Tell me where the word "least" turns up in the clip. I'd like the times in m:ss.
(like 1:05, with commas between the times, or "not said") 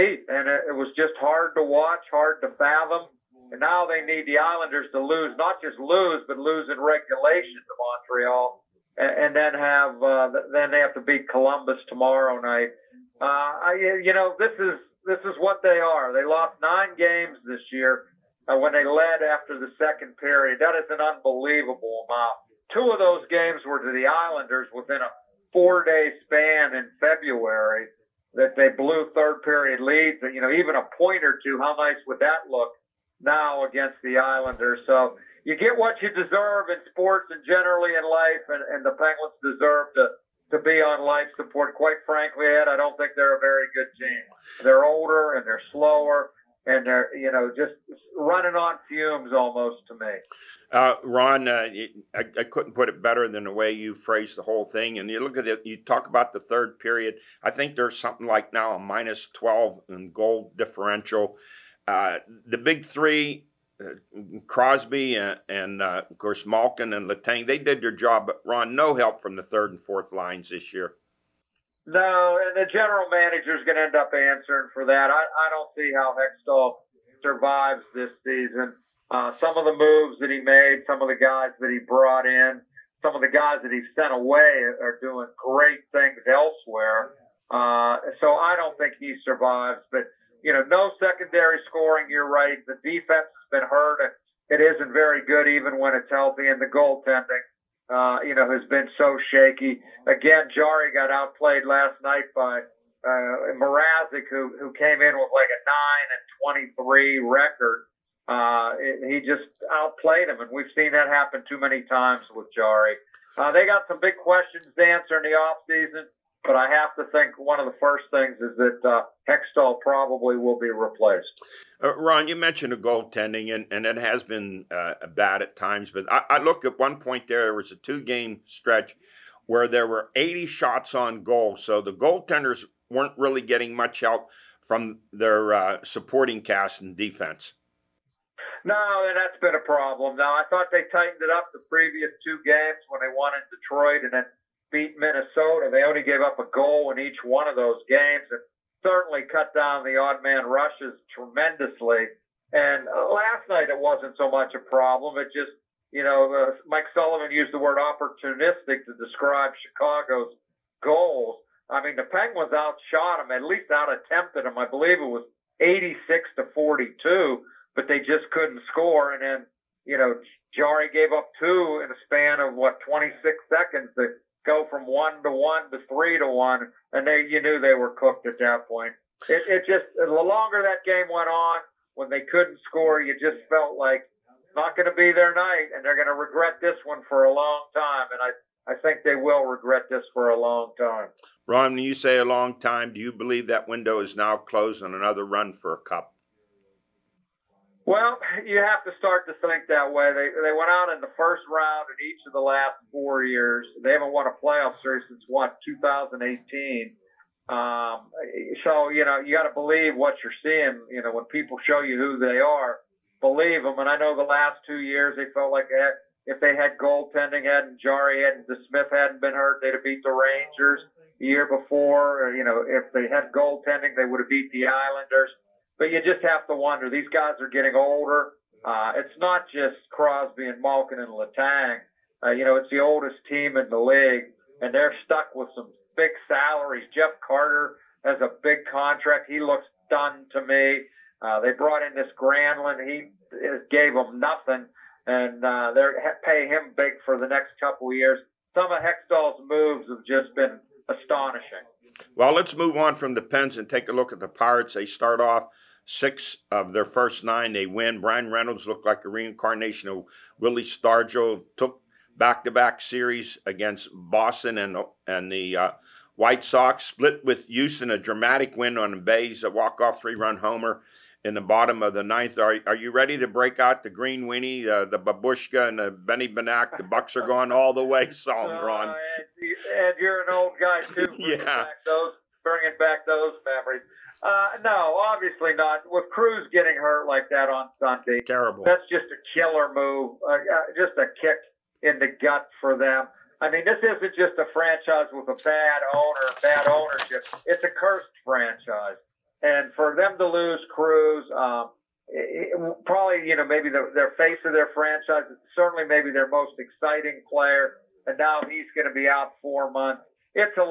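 2:43.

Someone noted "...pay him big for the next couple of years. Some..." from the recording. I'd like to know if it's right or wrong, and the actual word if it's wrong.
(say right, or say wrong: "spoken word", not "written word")
right.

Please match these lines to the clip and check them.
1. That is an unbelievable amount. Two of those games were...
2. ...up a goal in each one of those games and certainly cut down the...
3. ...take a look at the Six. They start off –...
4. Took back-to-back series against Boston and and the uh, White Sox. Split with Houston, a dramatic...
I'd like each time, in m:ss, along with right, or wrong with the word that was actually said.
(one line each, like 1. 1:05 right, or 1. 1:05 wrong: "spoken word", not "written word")
1. 0:20 right
2. 2:26 right
3. 4:13 wrong: "Pirates", not "Six"
4. 4:21 right.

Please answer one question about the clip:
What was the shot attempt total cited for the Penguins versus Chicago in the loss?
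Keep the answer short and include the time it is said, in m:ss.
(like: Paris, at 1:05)
86 to 42, at 2:45.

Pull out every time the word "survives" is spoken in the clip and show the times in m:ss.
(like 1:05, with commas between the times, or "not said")
1:17, 1:29.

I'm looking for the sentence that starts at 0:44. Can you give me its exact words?
They're older and they're slower and they're you know just running on fumes almost to me.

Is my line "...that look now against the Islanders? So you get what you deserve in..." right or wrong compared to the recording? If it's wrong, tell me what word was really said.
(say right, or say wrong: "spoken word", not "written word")
right.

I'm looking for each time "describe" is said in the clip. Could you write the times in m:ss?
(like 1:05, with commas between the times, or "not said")
2:38.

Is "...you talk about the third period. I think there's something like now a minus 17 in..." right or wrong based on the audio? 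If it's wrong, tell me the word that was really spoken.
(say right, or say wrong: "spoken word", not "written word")
wrong: "12", not "17".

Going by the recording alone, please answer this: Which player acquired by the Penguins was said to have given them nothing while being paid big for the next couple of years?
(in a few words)
Granlund.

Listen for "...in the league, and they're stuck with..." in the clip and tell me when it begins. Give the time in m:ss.
3:53.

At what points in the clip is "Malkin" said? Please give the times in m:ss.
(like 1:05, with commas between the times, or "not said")
1:06, 3:50.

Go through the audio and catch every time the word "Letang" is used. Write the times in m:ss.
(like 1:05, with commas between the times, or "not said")
1:07, 3:51.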